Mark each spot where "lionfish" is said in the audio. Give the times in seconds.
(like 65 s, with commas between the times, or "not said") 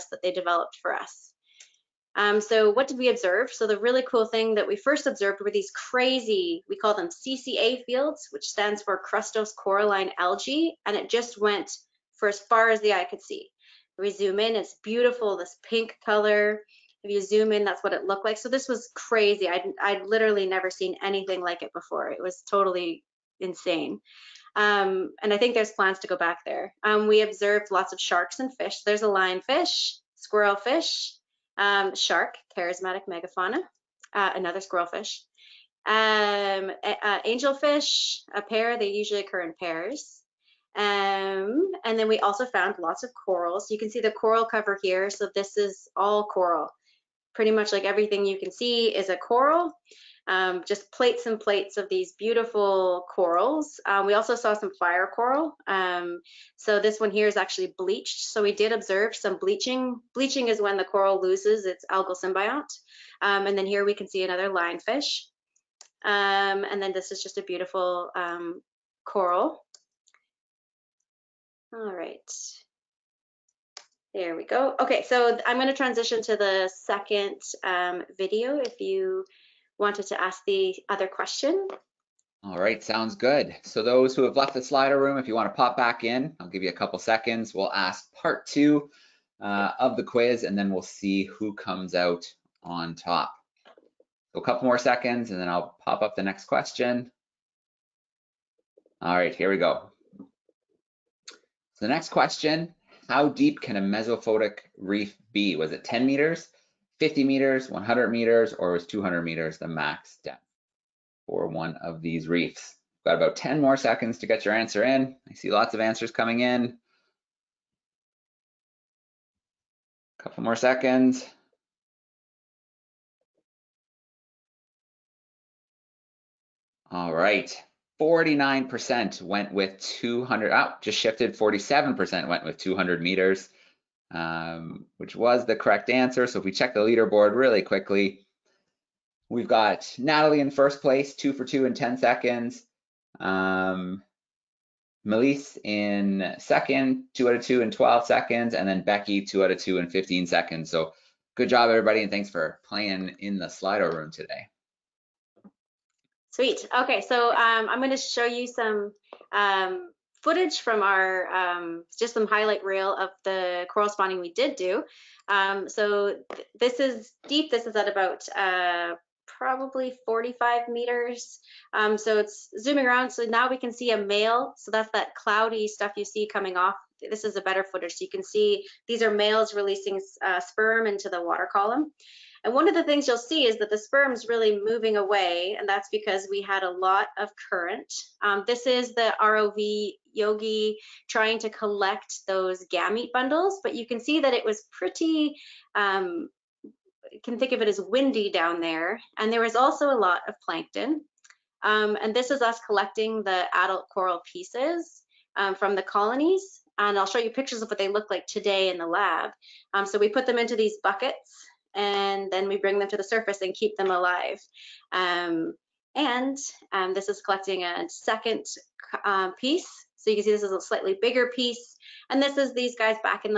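29 s, 64 s.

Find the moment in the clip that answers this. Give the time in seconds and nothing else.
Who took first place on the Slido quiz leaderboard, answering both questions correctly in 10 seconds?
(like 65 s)
139 s.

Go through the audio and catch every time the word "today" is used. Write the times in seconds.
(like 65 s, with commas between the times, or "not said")
154 s, 208 s.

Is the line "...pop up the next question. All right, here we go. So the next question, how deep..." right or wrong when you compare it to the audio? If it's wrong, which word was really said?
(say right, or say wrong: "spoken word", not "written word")
right.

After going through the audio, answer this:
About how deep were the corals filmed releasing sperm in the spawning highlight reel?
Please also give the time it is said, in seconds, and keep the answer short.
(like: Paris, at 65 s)
45 meters, at 170 s.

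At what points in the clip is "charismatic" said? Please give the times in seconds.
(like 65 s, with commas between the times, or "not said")
32 s.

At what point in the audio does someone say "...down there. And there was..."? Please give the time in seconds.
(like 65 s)
198 s.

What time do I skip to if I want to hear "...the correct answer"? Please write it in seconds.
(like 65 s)
135 s.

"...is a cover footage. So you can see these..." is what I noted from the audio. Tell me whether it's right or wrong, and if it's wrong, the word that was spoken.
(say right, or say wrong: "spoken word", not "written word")
wrong: "better", not "cover".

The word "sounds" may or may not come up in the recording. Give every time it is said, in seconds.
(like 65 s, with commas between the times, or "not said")
82 s.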